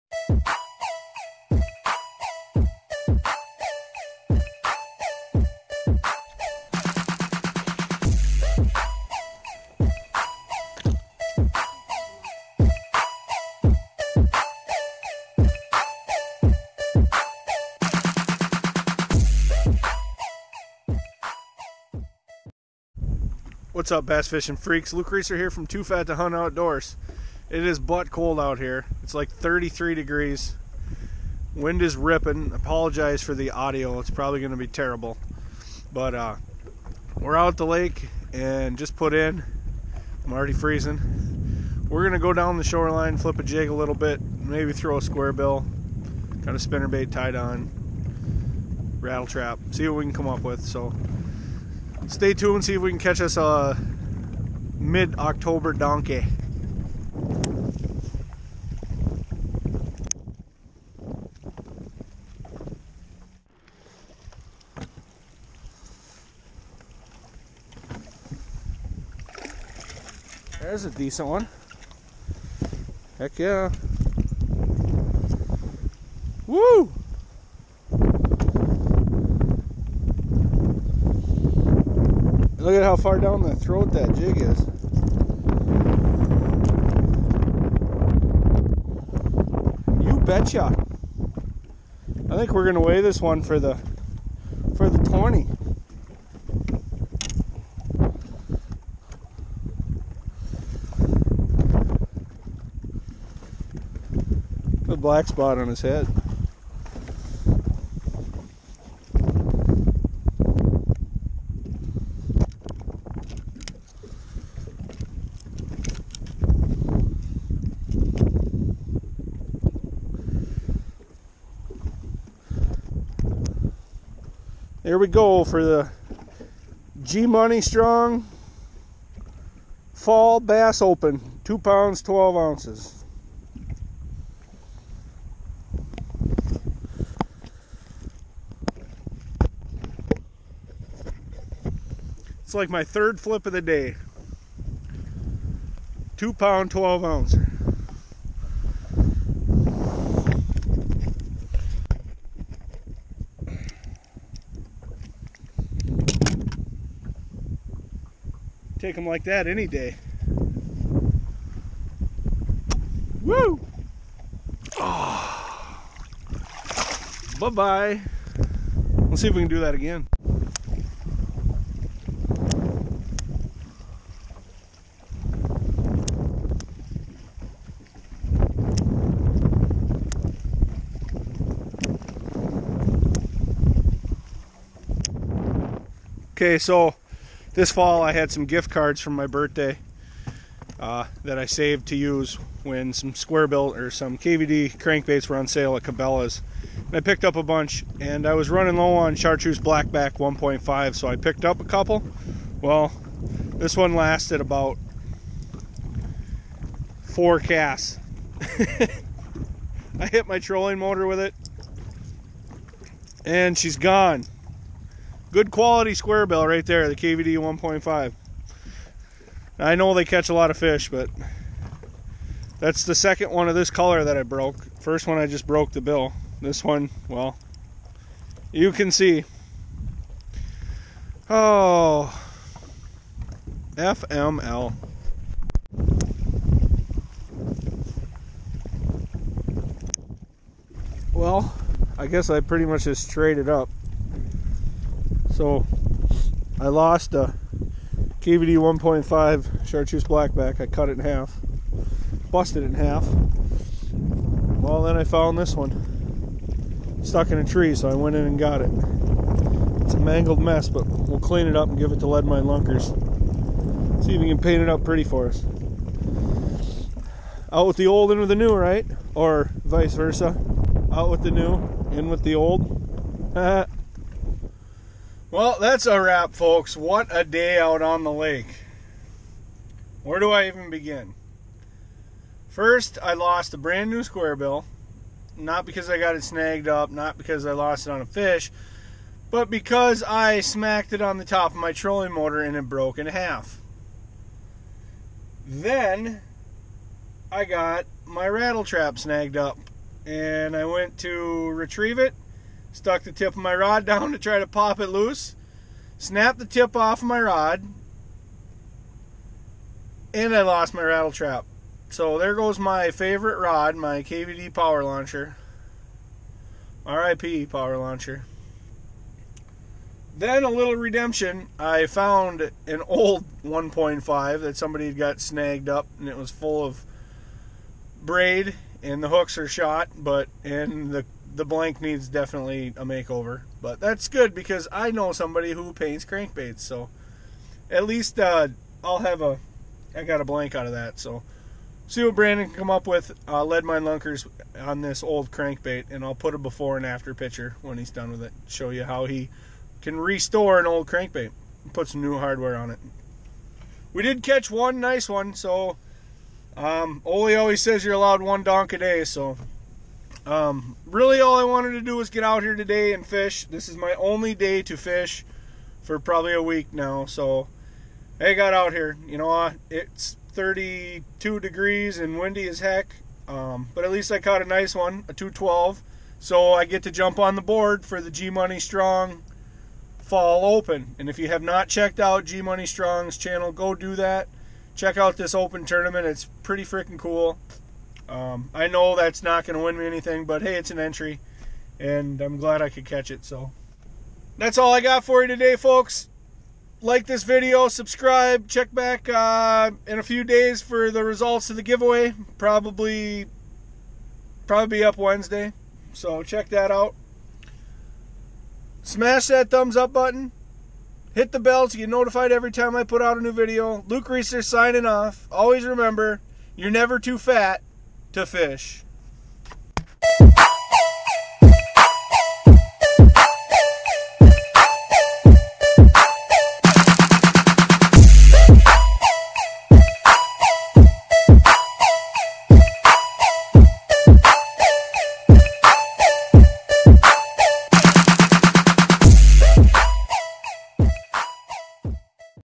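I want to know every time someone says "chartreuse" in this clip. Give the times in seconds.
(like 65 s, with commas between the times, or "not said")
199 s, 249 s.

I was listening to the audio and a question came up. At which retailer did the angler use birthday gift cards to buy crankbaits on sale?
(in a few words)
Cabela's.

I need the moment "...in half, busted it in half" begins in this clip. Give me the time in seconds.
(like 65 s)
250 s.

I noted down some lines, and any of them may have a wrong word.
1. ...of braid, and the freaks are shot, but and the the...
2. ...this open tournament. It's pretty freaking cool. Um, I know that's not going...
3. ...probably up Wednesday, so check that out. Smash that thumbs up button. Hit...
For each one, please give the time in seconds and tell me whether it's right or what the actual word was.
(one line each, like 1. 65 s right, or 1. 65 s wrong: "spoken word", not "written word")
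1. 326 s wrong: "hooks", not "freaks"
2. 385 s right
3. 404 s right.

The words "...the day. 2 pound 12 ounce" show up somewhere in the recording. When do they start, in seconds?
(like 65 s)
143 s.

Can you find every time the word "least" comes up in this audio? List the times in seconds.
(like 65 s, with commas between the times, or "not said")
337 s, 373 s.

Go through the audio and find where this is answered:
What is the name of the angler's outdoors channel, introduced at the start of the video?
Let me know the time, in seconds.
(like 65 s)
25 s.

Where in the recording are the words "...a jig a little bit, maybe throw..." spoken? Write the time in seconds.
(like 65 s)
43 s.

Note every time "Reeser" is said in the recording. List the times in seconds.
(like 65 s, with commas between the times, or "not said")
25 s, 414 s.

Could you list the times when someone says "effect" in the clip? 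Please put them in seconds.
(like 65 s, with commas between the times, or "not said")
not said.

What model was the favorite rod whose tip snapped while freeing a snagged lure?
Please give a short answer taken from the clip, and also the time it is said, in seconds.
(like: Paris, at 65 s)
KVD power launcher, at 314 s.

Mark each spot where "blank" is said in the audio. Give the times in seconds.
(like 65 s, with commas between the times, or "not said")
331 s, 340 s.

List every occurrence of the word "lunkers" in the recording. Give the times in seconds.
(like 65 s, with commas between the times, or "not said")
262 s, 343 s.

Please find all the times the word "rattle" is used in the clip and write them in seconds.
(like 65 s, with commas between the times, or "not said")
49 s, 298 s, 310 s.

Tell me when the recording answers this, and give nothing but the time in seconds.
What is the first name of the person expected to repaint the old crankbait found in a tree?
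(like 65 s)
342 s.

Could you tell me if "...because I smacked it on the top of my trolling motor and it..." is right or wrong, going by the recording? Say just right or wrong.
right.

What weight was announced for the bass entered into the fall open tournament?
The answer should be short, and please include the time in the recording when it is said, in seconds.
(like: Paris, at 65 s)
2 pounds 12 ounces, at 131 s.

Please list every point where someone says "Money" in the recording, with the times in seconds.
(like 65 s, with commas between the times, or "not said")
127 s, 378 s, 382 s.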